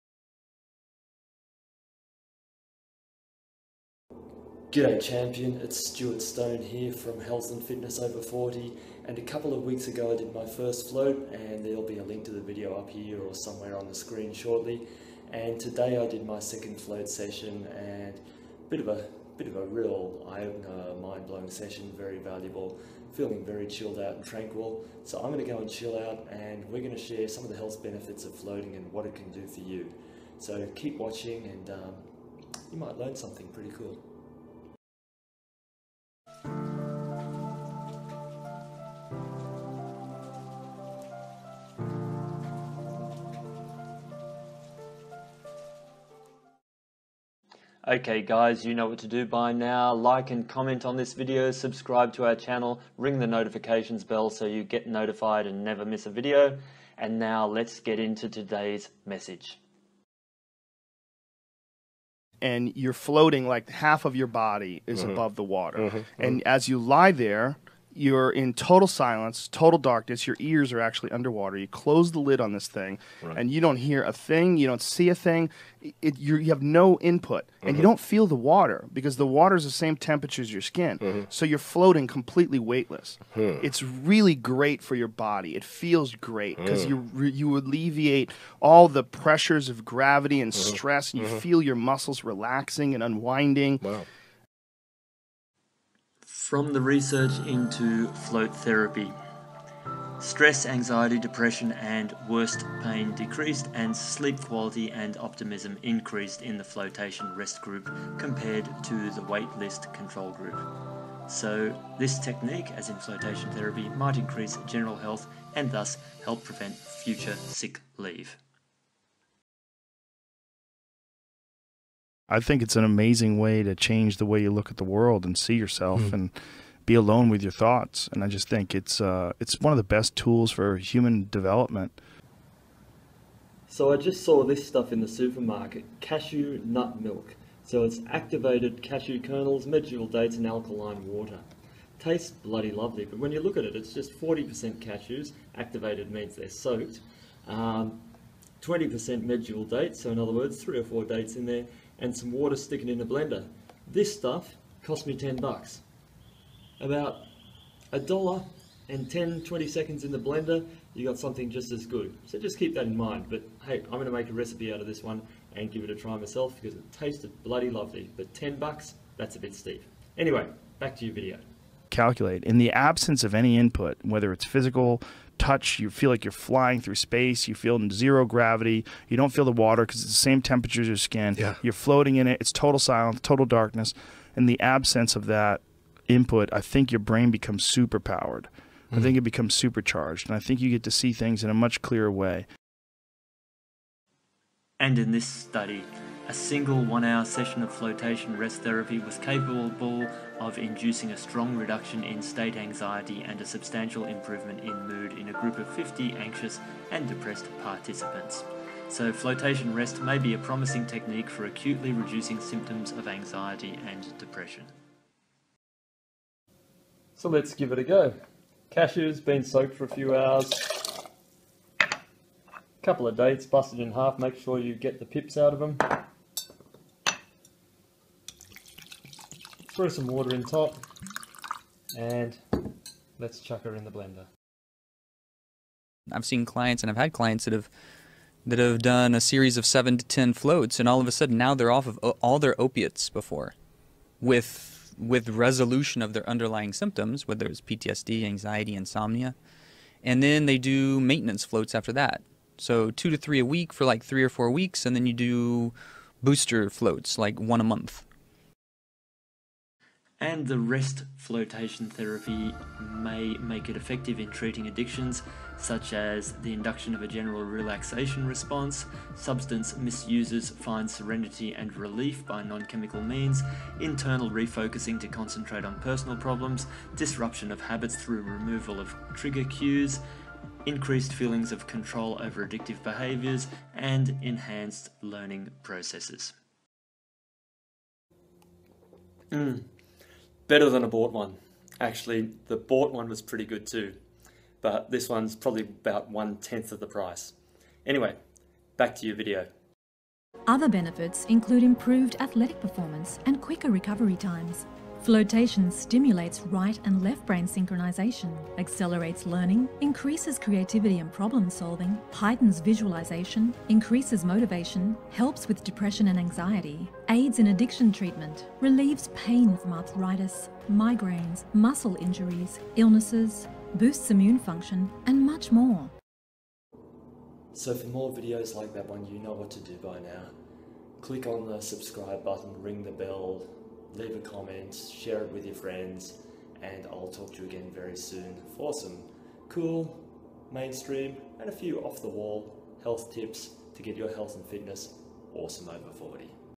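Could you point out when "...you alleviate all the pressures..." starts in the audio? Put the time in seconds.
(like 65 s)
87 s.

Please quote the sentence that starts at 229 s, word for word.
throw some water in top, and let's chuck her in the blender.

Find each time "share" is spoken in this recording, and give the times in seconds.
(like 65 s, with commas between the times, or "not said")
26 s, 334 s.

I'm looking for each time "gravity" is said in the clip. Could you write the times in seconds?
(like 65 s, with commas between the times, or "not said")
89 s, 178 s.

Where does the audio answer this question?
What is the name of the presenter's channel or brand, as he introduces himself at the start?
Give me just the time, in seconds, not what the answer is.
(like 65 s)
7 s.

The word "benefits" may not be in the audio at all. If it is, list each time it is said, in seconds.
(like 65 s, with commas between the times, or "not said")
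27 s, 300 s.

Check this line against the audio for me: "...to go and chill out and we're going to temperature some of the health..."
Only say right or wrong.
wrong.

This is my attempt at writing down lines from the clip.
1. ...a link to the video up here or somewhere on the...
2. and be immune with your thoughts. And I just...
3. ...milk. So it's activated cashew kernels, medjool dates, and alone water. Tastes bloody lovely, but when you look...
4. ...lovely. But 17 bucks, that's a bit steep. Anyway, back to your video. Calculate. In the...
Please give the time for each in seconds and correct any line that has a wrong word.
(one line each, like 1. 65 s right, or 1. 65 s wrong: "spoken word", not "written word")
1. 11 s right
2. 126 s wrong: "alone", not "immune"
3. 137 s wrong: "alkaline", not "alone"
4. 167 s wrong: "10", not "17".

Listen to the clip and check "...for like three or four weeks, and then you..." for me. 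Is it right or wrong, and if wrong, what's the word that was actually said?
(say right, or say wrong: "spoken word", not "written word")
right.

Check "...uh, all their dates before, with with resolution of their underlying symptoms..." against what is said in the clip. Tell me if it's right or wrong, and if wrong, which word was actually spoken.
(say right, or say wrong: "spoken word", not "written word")
wrong: "opiates", not "dates".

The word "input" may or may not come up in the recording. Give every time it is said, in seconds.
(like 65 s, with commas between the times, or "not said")
77 s, 173 s, 186 s.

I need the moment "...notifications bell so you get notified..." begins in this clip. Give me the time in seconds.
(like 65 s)
53 s.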